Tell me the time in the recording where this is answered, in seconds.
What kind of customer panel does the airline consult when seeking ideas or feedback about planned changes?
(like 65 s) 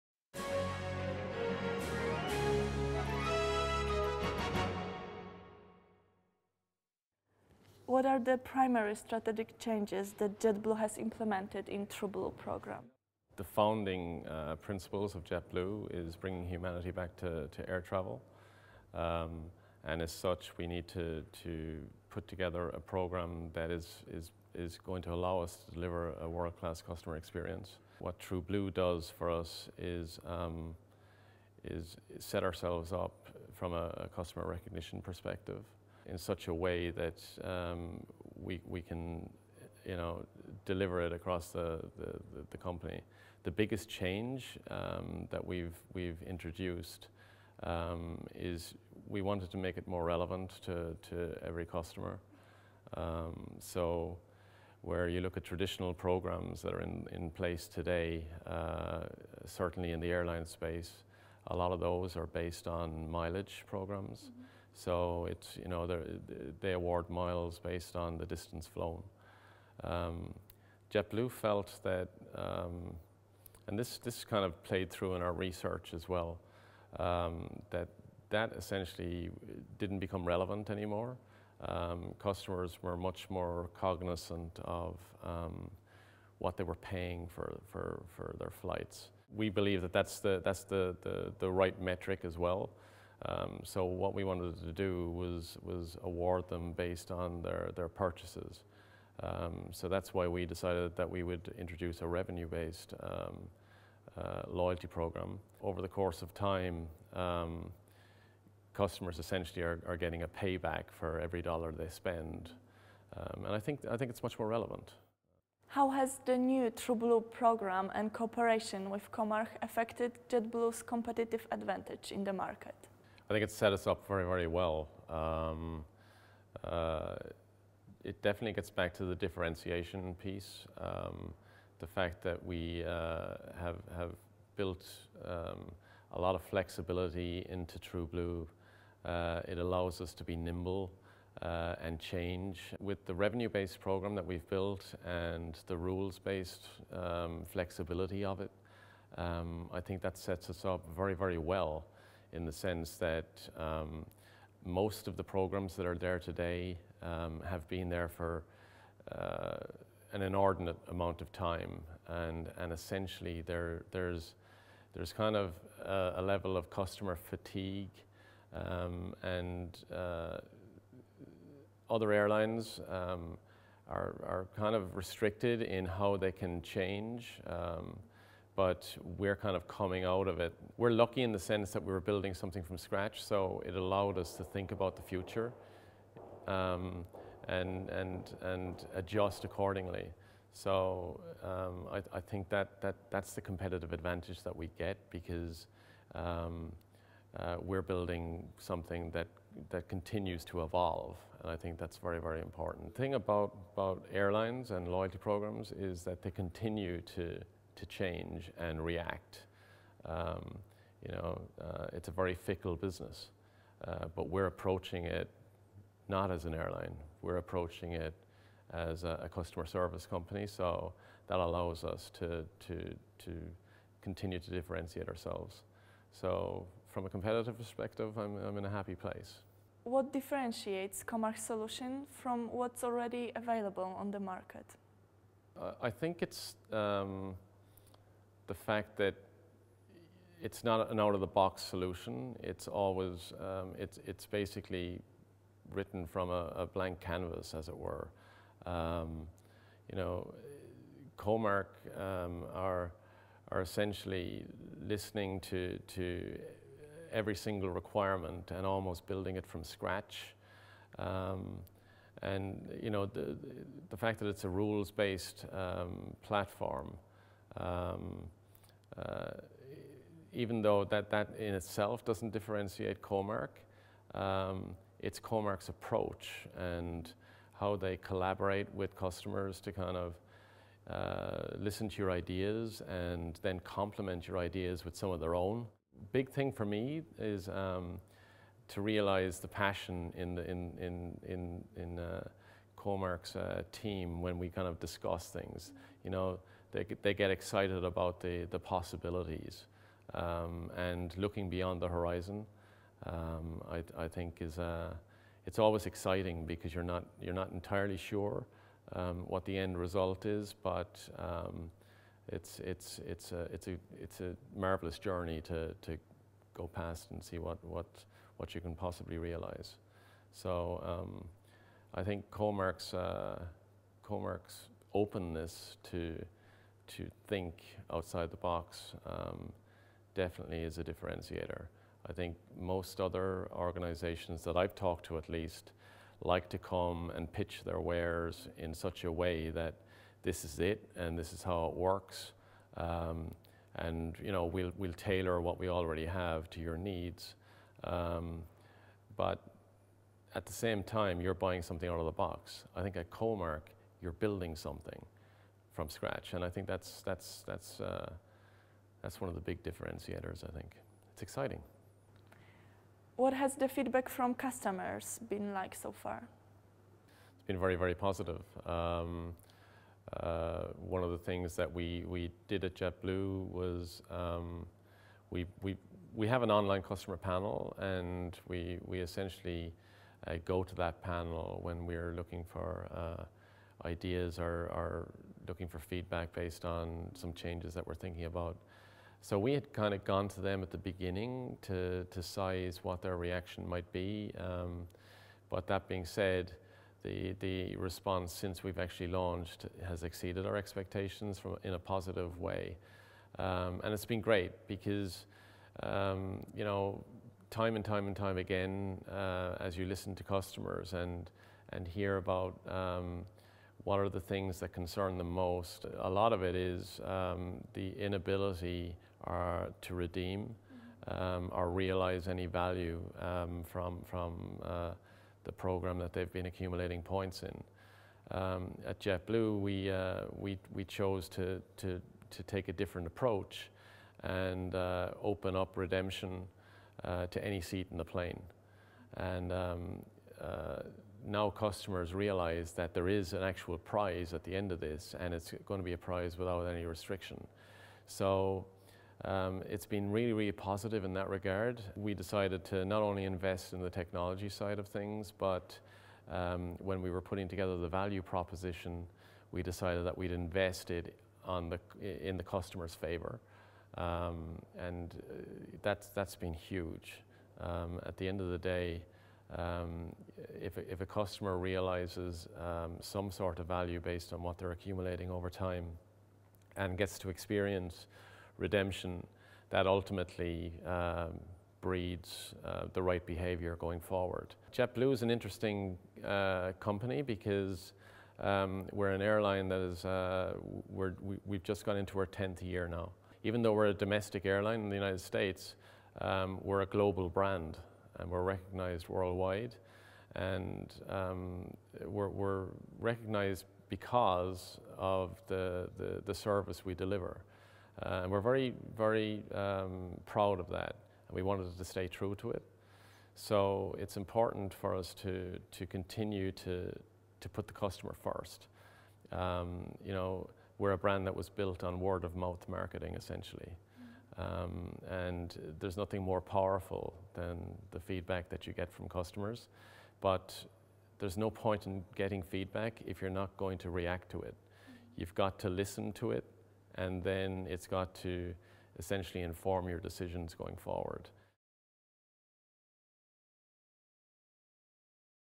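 376 s.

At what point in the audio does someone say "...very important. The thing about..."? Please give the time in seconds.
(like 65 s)
202 s.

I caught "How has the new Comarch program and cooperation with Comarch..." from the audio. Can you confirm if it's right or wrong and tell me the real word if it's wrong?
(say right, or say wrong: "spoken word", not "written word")
wrong: "TrueBlue", not "Comarch".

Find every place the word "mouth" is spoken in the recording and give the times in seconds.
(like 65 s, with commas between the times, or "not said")
522 s.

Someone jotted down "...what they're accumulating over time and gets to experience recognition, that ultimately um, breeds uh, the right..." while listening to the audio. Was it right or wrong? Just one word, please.
wrong.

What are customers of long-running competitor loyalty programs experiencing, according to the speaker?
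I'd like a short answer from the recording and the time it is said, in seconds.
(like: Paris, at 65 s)
customer fatigue, at 166 s.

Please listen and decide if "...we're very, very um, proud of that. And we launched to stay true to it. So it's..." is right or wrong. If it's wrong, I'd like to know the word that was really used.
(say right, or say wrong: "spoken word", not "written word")
wrong: "wanted", not "launched".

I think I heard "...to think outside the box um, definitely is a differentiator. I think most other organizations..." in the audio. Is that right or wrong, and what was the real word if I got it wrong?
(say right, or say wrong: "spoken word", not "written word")
right.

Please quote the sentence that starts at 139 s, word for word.
Uh, it allows us to be nimble uh, and change.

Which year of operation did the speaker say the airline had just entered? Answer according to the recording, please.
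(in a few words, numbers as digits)
10th year.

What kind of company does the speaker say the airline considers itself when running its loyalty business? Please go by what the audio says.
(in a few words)
customer service company.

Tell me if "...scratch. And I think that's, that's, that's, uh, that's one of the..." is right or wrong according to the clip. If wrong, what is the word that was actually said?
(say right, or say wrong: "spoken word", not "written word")
right.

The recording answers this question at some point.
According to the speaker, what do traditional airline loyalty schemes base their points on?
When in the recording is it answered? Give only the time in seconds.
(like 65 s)
63 s.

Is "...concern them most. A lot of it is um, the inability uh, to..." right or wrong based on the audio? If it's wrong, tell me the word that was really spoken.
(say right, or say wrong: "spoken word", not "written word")
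right.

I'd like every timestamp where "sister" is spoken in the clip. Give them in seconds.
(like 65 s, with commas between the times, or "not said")
not said.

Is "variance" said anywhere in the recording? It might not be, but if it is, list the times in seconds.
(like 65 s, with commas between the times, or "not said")
not said.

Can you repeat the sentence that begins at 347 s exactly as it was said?
Um, but at the same time, you're buying something out of the box.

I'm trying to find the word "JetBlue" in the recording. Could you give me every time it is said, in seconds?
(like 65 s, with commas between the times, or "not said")
10 s, 15 s, 70 s, 120 s, 372 s, 428 s, 484 s.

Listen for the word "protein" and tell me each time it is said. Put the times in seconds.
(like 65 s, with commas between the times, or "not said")
not said.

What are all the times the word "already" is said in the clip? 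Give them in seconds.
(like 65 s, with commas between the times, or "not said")
232 s, 345 s.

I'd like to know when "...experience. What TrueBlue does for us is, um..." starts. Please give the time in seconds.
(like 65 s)
27 s.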